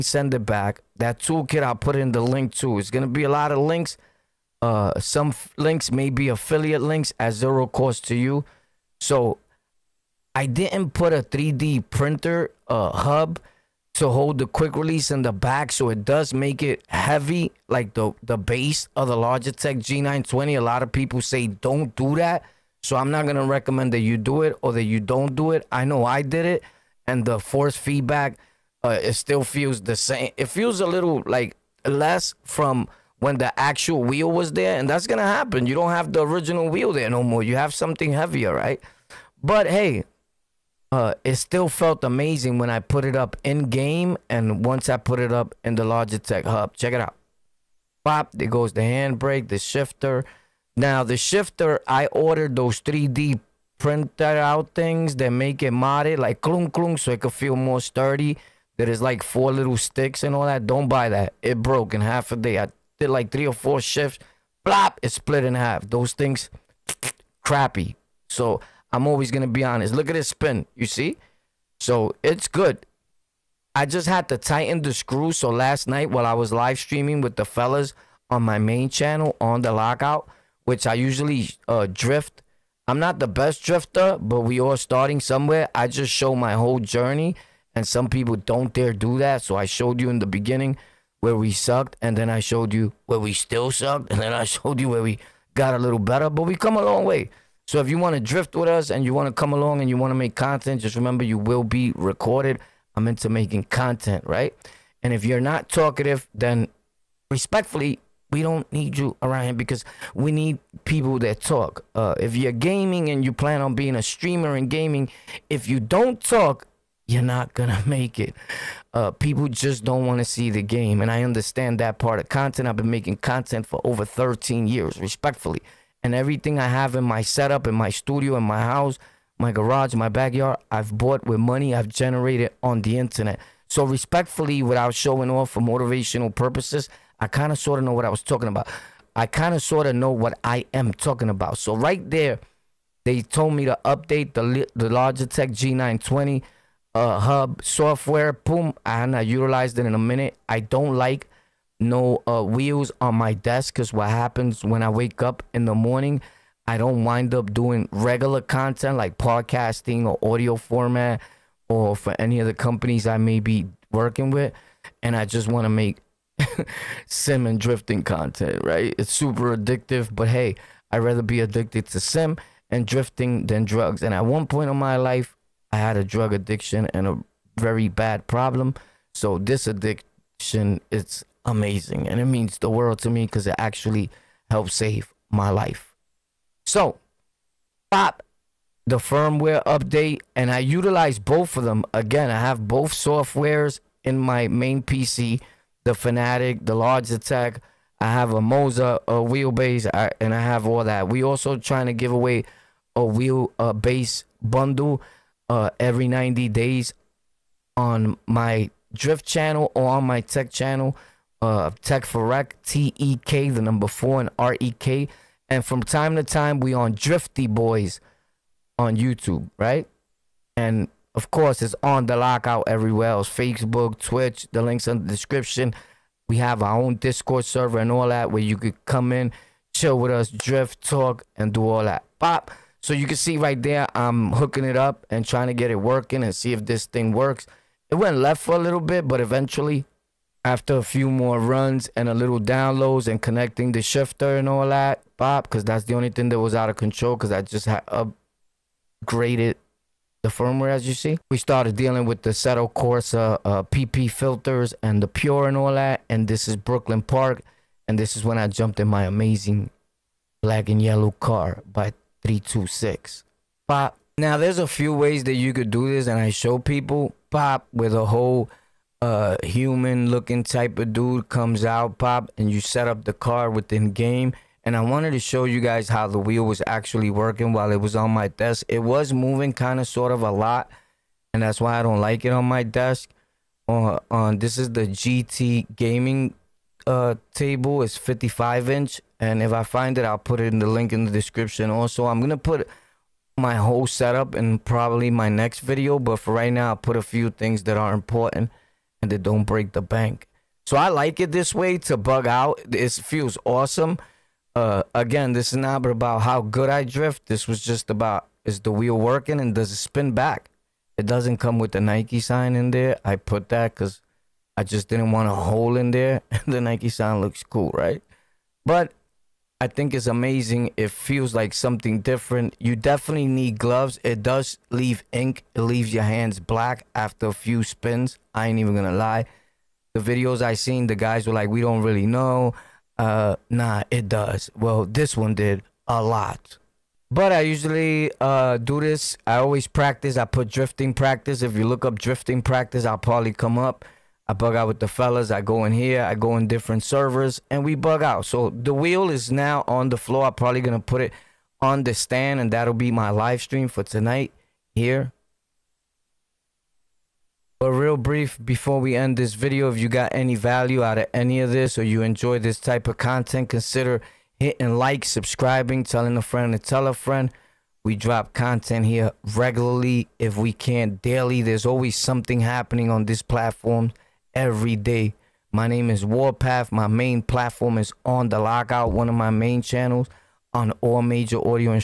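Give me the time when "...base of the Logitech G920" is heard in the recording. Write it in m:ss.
0:18.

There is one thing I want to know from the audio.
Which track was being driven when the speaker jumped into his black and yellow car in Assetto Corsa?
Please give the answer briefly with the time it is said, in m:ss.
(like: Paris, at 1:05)
Brooklyn Park, at 4:16.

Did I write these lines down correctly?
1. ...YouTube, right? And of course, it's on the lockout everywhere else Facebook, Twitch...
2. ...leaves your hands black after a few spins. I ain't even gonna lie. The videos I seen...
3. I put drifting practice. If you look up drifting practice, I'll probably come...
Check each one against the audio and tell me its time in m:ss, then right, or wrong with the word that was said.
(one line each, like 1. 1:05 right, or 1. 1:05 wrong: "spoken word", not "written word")
1. 3:38 right
2. 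5:25 right
3. 5:40 right.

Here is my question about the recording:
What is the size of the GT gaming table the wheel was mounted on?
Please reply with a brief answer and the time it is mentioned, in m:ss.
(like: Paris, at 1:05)
55 inch, at 4:47.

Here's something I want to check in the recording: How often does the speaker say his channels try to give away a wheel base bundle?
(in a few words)
every 90 days.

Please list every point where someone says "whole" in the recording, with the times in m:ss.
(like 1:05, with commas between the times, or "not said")
1:26, 4:28, 4:53.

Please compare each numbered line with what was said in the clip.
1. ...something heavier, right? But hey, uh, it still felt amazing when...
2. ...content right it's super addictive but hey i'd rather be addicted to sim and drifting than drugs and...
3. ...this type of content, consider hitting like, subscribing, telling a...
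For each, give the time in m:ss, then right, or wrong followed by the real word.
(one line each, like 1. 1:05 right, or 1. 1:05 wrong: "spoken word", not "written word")
1. 0:37 right
2. 2:48 right
3. 6:02 right.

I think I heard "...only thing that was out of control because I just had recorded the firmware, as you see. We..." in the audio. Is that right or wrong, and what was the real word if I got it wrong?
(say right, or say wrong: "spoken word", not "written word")
wrong: "upgraded", not "recorded".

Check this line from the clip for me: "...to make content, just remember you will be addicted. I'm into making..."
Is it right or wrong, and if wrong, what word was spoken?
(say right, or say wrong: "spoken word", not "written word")
wrong: "recorded", not "addicted".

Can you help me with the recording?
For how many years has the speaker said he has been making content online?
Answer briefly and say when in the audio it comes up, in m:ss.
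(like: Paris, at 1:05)
13 years, at 2:04.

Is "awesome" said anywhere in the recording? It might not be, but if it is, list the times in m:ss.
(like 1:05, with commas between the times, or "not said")
5:03.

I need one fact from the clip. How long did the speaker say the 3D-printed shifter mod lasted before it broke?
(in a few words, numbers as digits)
half a day.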